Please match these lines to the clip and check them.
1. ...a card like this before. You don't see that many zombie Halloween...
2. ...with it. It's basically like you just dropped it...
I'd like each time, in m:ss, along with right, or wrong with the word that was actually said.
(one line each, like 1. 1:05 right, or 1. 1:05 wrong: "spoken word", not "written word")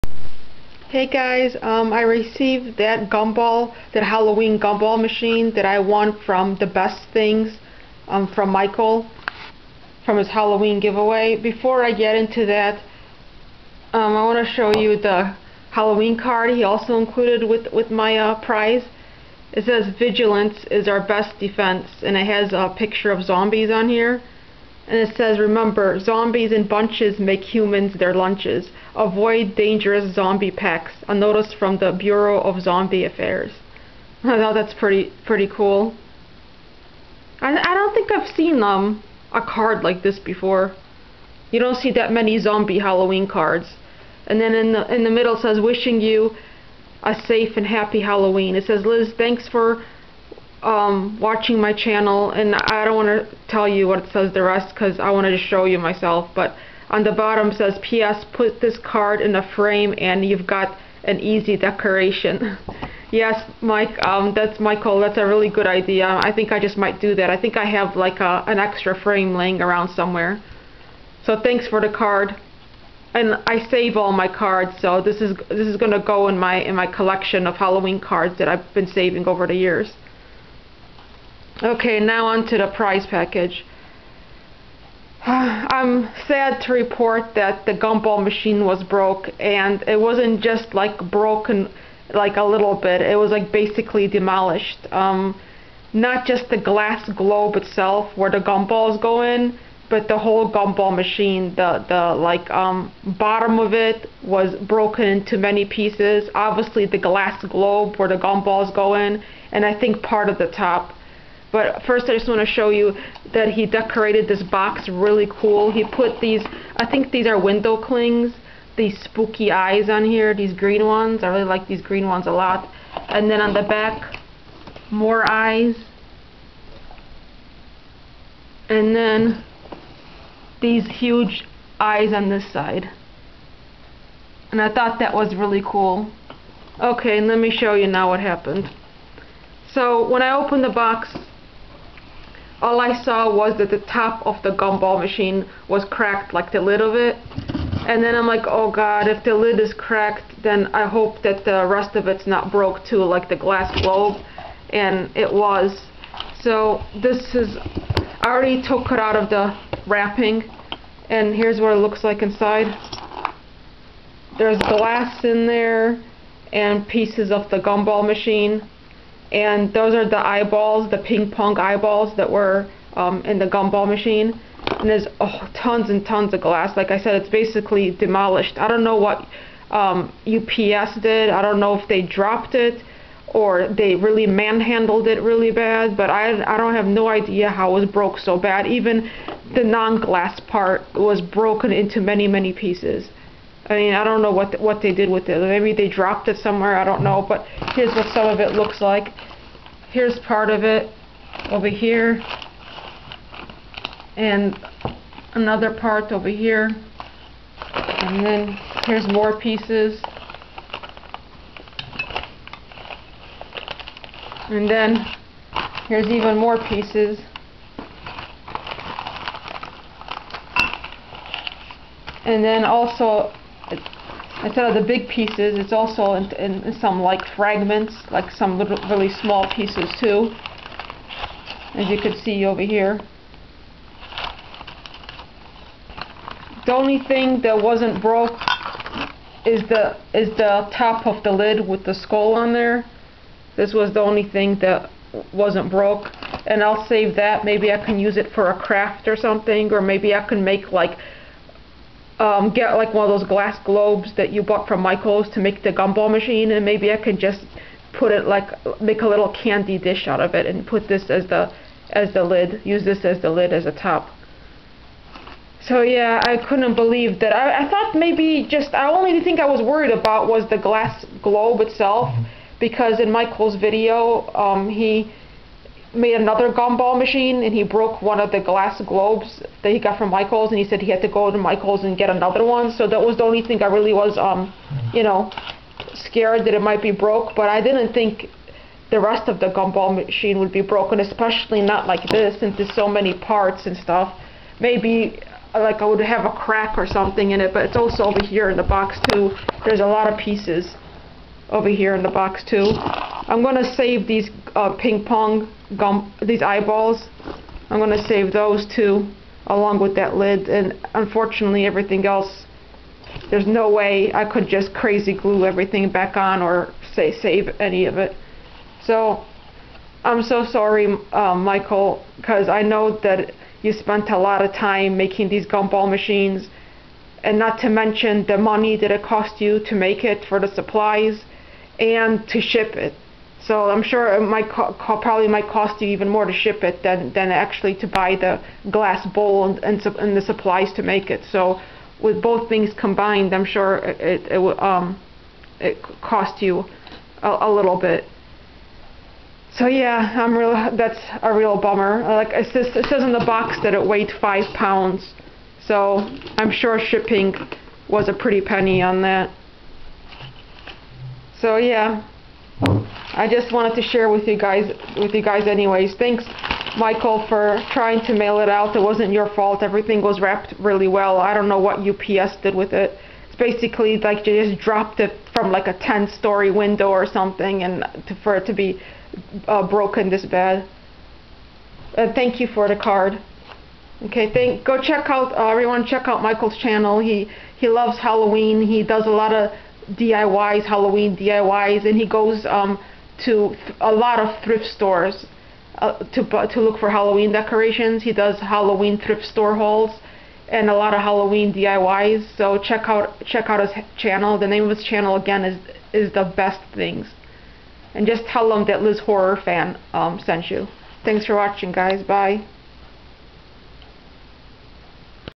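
1. 0:39 right
2. 6:12 right.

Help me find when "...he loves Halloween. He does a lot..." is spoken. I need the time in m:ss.
6:27.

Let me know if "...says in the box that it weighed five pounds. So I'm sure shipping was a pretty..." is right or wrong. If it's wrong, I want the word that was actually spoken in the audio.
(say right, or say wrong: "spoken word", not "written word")
right.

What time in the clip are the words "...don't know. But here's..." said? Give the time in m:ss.
3:16.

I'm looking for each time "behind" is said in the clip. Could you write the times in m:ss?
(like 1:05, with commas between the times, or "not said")
not said.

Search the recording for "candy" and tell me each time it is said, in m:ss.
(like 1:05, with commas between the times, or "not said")
4:19.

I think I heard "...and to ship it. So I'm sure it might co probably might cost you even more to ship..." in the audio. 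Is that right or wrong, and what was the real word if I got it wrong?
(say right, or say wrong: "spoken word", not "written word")
right.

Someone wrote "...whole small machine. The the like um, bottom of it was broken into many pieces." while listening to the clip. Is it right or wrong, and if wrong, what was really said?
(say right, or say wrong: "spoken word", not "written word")
wrong: "gumball", not "small".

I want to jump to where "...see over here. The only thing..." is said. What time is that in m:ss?
3:52.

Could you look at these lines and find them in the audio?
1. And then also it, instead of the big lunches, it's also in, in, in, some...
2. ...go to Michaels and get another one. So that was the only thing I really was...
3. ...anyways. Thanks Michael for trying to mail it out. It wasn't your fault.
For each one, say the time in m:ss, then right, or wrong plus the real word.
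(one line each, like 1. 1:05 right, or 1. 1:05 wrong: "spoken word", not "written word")
1. 3:42 wrong: "pieces", not "lunches"
2. 4:41 right
3. 6:05 right.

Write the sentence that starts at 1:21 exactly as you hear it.
Okay, now on to the prize package.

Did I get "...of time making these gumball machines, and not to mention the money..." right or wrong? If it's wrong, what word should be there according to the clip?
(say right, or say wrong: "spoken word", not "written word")
right.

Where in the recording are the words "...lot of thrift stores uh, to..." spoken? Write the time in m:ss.
6:33.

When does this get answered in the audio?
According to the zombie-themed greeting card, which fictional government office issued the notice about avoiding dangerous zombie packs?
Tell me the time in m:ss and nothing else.
0:31.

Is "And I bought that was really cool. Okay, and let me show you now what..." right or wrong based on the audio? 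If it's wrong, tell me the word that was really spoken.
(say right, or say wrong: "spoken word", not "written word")
wrong: "thought", not "bought".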